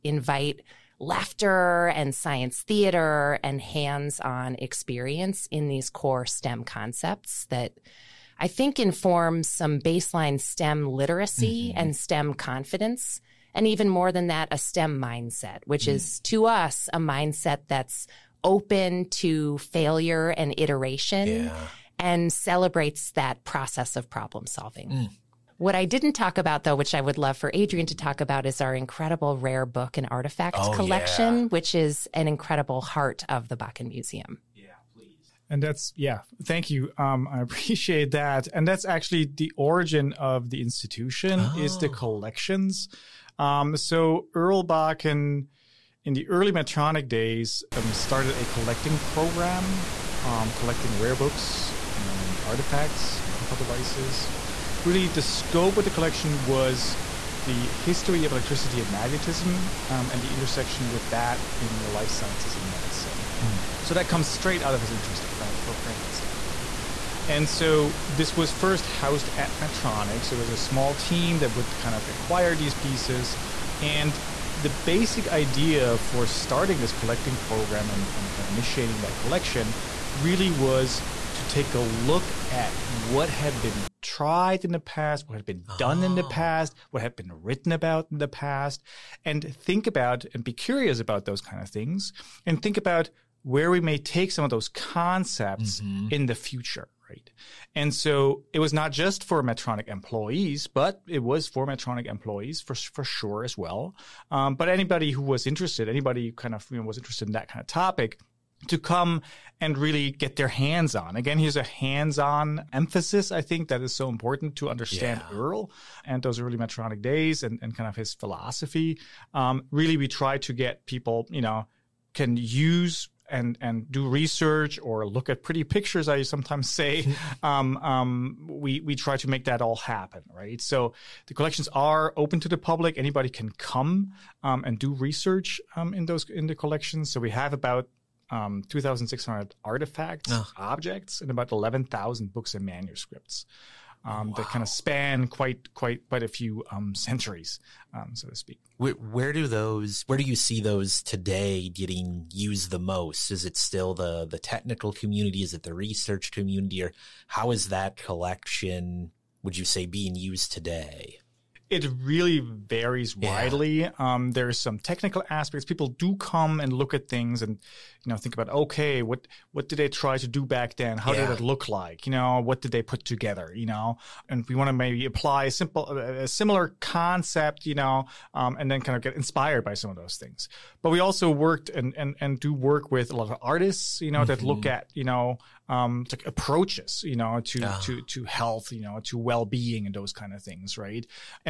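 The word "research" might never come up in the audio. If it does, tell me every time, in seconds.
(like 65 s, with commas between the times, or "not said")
124 s, 134 s, 155 s.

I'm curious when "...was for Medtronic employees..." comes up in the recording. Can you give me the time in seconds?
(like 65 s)
101 s.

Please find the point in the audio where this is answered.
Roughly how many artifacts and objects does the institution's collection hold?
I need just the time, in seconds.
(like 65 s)
138 s.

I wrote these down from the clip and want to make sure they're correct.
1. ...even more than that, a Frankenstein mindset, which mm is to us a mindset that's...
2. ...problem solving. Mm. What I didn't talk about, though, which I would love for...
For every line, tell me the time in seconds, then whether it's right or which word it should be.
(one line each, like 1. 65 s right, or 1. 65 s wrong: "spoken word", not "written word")
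1. 13 s wrong: "STEM", not "Frankenstein"
2. 24 s right.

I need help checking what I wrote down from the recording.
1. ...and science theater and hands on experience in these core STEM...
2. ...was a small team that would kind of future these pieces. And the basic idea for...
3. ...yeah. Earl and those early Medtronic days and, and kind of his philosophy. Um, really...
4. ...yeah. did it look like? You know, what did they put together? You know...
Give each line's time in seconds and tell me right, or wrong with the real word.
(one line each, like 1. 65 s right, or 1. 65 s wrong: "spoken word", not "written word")
1. 1 s right
2. 70 s wrong: "acquire", not "future"
3. 115 s right
4. 171 s right.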